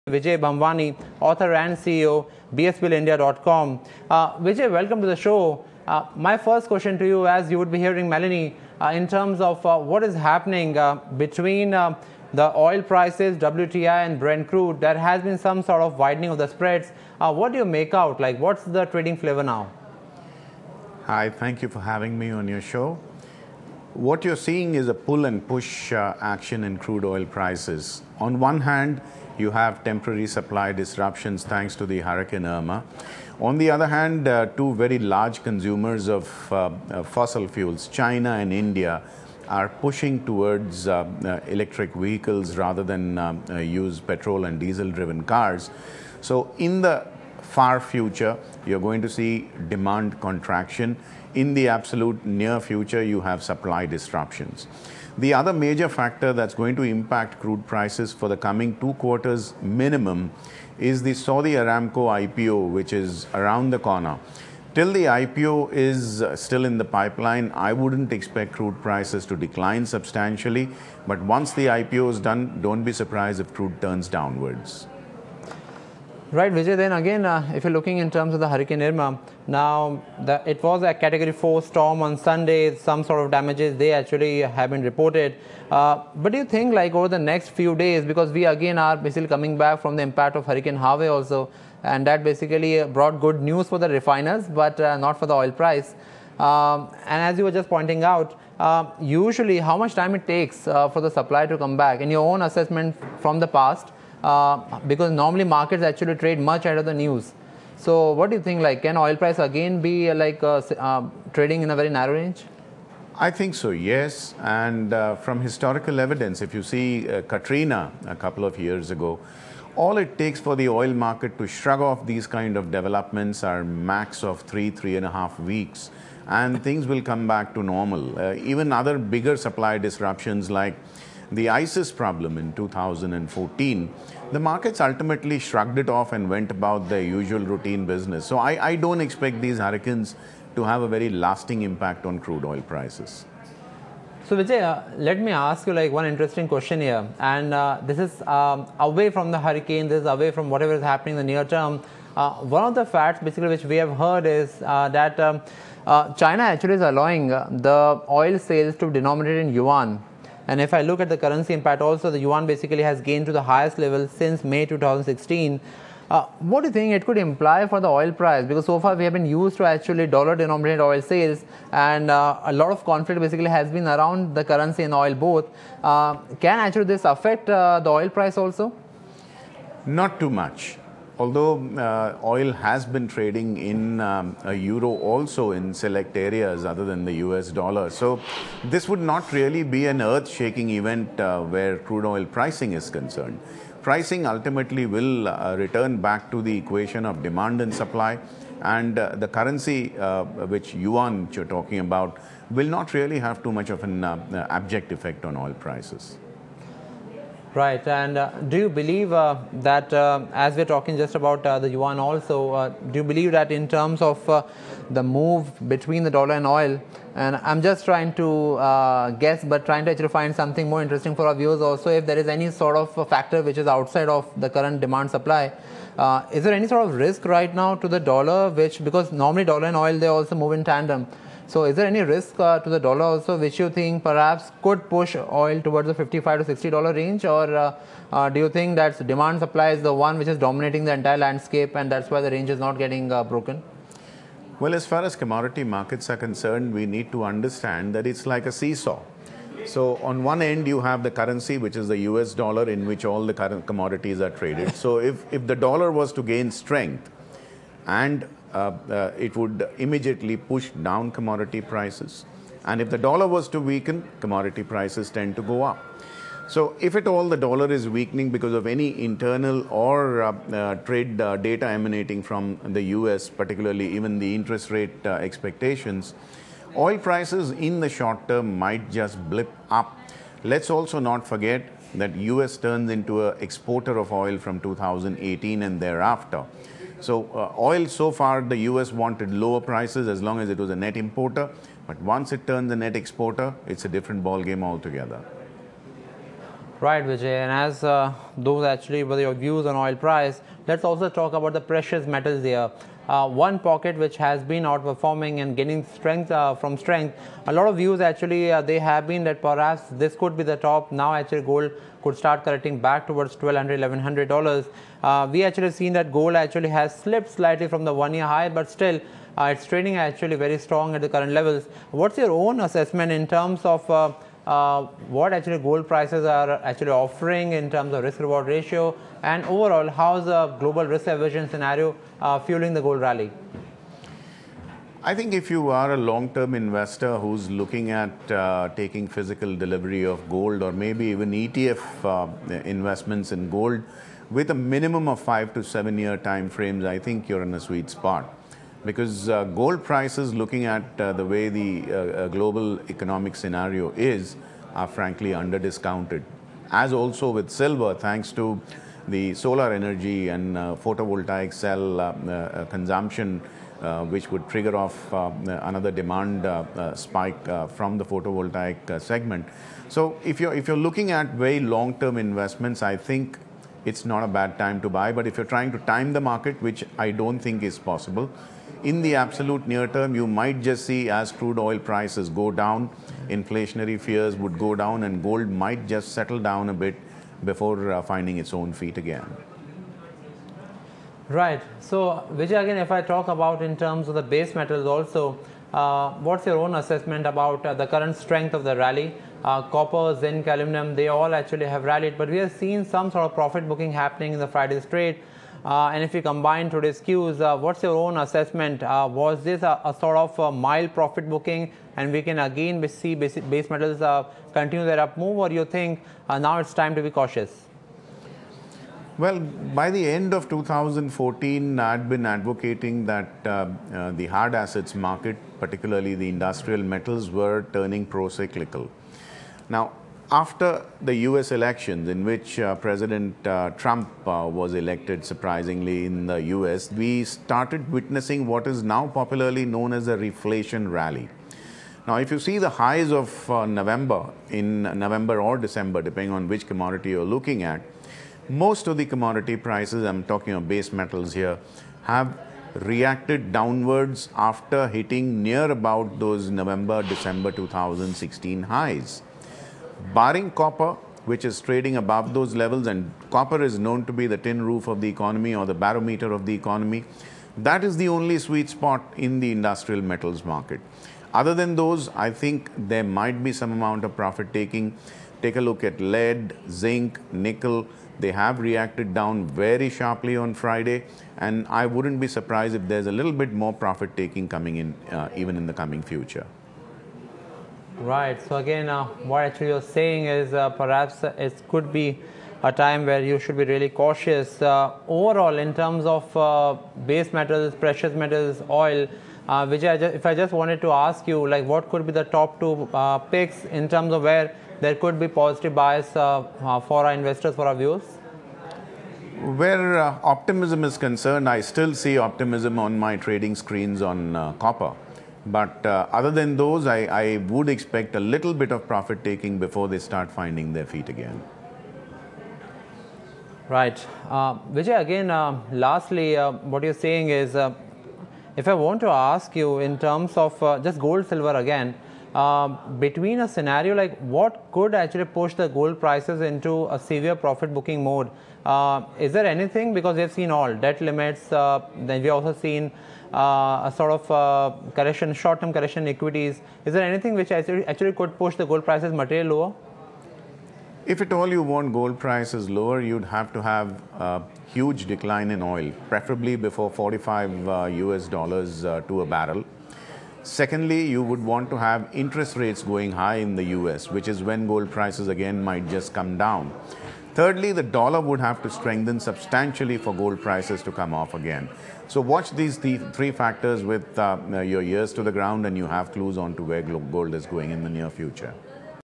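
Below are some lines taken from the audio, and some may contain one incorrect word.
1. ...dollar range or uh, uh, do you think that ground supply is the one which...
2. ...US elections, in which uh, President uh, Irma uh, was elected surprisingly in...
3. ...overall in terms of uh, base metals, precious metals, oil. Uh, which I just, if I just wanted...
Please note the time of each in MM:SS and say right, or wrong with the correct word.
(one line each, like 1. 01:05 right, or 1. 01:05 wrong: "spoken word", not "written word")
1. 03:56 wrong: "demand", not "ground"
2. 07:11 wrong: "Trump", not "Irma"
3. 08:15 right.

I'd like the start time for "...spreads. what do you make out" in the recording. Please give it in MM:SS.
00:16.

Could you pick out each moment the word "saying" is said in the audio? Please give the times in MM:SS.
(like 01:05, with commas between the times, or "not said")
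08:09, 08:46.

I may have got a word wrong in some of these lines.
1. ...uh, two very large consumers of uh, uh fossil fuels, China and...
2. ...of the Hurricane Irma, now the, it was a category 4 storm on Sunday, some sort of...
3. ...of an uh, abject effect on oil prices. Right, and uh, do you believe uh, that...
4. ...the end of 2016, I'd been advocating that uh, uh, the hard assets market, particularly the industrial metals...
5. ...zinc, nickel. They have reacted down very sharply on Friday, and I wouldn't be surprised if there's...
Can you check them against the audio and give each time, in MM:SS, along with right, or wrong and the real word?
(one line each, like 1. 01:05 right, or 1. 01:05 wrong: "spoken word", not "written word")
1. 00:34 right
2. 01:18 right
3. 03:23 right
4. 06:59 wrong: "2014", not "2016"
5. 07:56 right.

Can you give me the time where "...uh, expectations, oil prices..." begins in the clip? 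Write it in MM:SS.
04:35.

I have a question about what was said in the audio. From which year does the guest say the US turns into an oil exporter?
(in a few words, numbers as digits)
2018.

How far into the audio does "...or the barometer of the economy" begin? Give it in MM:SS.
07:45.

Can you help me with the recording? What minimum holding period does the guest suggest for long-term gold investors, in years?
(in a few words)
5 to 7 years.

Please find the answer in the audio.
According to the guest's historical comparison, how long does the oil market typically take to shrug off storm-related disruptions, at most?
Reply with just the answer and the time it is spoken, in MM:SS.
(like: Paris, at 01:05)
3.5 weeks, at 02:04.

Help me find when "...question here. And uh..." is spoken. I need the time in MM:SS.
02:26.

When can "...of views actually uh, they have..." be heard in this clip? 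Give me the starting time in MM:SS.
05:07.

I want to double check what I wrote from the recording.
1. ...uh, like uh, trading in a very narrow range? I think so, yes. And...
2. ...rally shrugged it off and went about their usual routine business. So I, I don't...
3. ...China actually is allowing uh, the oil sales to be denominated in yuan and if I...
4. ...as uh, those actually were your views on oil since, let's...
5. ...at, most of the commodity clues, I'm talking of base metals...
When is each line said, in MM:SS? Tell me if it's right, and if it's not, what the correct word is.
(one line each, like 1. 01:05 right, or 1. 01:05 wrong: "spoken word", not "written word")
1. 01:50 right
2. 02:14 wrong: "ultimately", not "rally"
3. 02:36 right
4. 04:57 wrong: "price", not "since"
5. 07:27 wrong: "prices", not "clues".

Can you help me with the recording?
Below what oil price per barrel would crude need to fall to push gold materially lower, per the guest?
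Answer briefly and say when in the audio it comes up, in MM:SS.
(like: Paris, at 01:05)
45 US dollars, at 09:16.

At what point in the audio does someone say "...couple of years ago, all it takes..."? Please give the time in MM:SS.
01:58.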